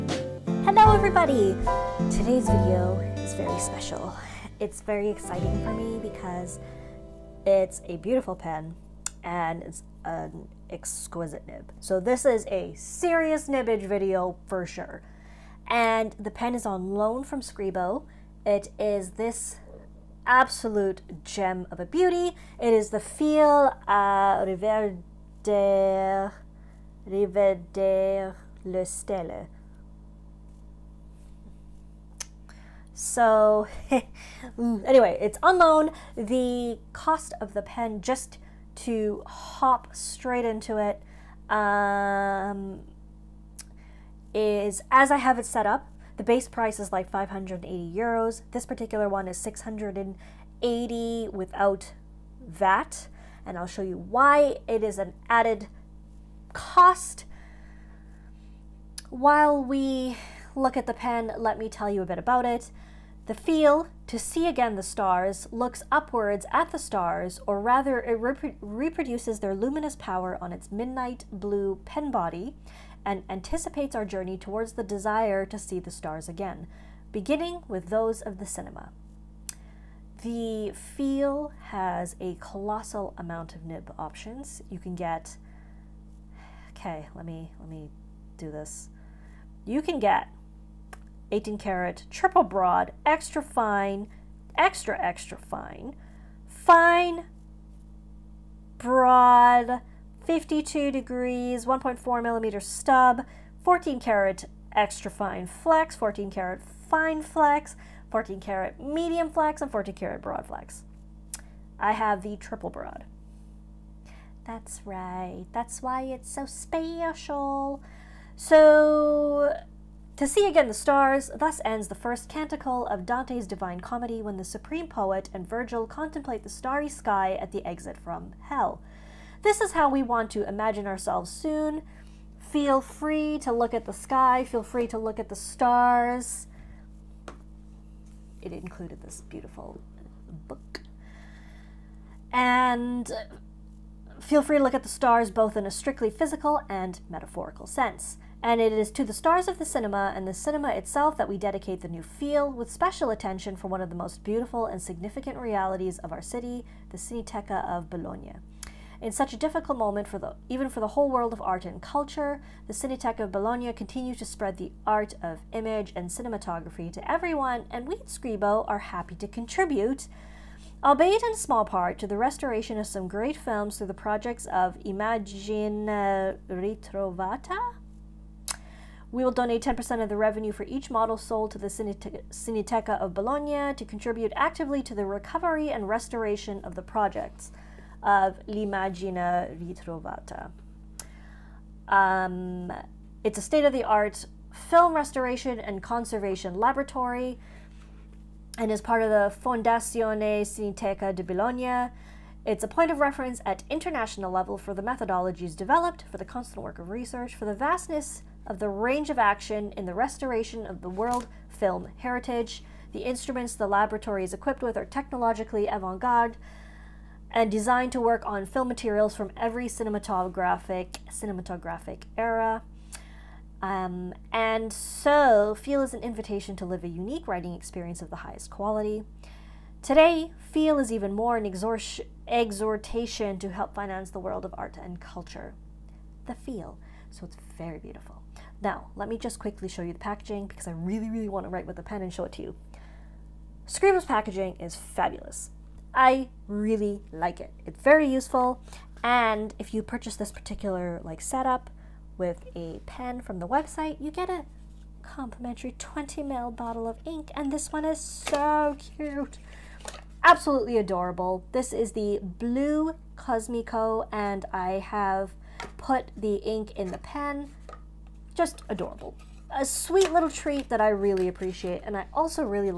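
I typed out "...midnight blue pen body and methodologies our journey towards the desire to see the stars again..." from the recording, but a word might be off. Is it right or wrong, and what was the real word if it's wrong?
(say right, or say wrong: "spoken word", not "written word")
wrong: "anticipates", not "methodologies".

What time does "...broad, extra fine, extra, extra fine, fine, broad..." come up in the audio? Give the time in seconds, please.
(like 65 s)
92 s.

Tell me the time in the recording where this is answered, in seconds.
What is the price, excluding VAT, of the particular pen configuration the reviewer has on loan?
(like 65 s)
49 s.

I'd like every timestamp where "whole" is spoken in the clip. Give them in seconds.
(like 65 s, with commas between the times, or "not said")
160 s.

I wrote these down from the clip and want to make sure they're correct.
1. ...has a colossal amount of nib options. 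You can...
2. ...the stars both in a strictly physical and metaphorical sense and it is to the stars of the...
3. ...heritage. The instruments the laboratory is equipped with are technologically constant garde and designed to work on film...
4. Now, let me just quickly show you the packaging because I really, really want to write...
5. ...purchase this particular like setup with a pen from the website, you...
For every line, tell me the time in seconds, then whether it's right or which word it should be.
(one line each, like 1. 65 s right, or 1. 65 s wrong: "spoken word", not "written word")
1. 81 s right
2. 144 s right
3. 211 s wrong: "avant", not "constant"
4. 238 s right
5. 249 s right.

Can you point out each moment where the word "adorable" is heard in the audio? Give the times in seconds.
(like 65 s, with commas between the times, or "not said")
260 s, 268 s.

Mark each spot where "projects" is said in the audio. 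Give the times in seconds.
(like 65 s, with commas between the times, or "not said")
173 s, 186 s.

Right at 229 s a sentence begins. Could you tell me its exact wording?
Today, Feel is even more an exor exhortation to help finance the world of art and culture.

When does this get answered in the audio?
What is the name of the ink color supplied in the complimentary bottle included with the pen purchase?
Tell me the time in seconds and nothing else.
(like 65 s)
262 s.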